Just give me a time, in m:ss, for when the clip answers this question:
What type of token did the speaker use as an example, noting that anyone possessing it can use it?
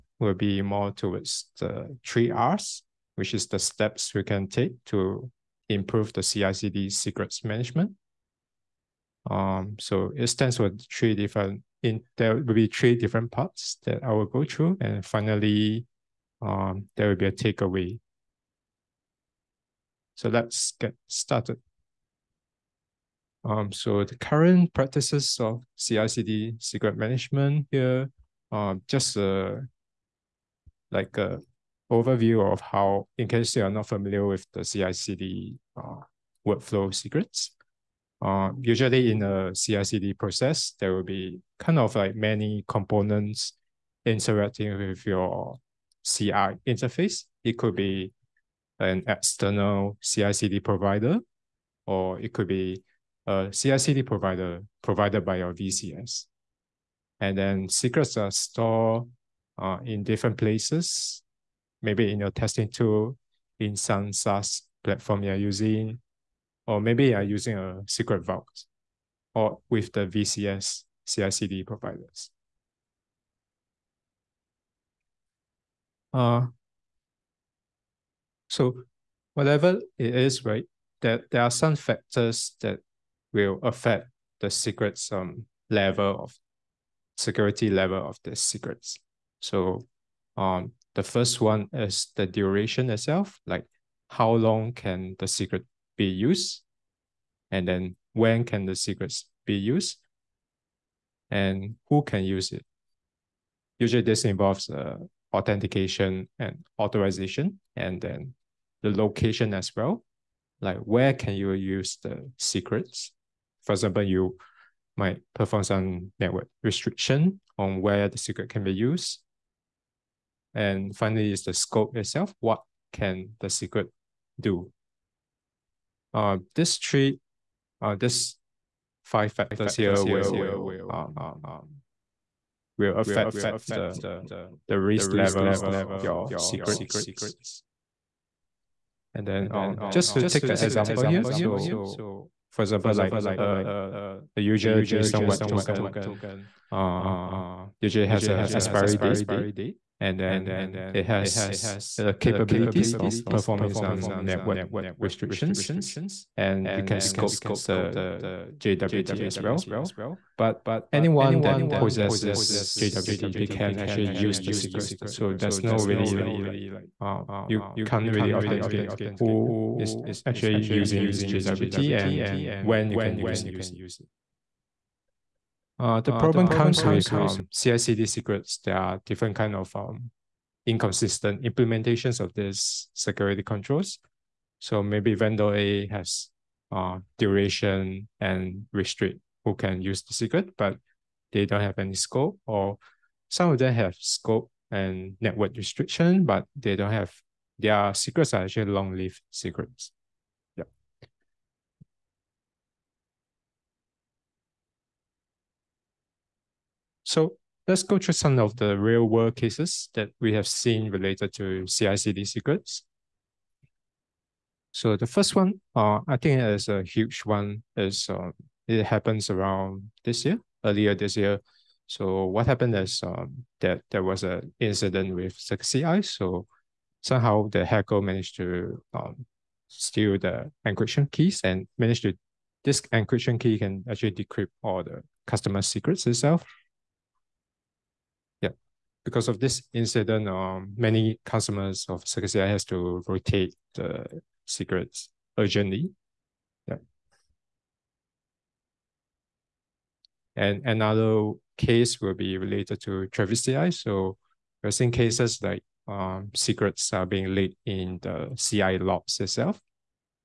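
2:24.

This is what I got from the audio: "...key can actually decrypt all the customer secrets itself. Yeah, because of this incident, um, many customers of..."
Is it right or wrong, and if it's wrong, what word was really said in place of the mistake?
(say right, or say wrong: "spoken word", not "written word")
right.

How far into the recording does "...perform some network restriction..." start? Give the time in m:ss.
1:55.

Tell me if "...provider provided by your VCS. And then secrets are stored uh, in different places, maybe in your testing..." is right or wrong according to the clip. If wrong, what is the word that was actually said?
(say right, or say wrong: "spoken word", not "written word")
right.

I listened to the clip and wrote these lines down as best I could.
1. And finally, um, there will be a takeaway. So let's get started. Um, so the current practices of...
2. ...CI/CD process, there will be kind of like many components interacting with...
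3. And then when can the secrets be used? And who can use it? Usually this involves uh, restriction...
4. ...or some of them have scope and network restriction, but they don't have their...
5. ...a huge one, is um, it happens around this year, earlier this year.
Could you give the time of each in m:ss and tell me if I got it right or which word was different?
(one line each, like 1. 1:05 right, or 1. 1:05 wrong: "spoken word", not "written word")
1. 0:14 right
2. 0:39 right
3. 1:37 wrong: "authentication", not "restriction"
4. 3:12 right
5. 3:36 right.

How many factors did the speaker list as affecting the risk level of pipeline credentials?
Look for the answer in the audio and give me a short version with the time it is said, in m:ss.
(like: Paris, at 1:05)
5, at 2:09.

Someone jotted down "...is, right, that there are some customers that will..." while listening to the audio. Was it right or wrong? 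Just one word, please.
wrong.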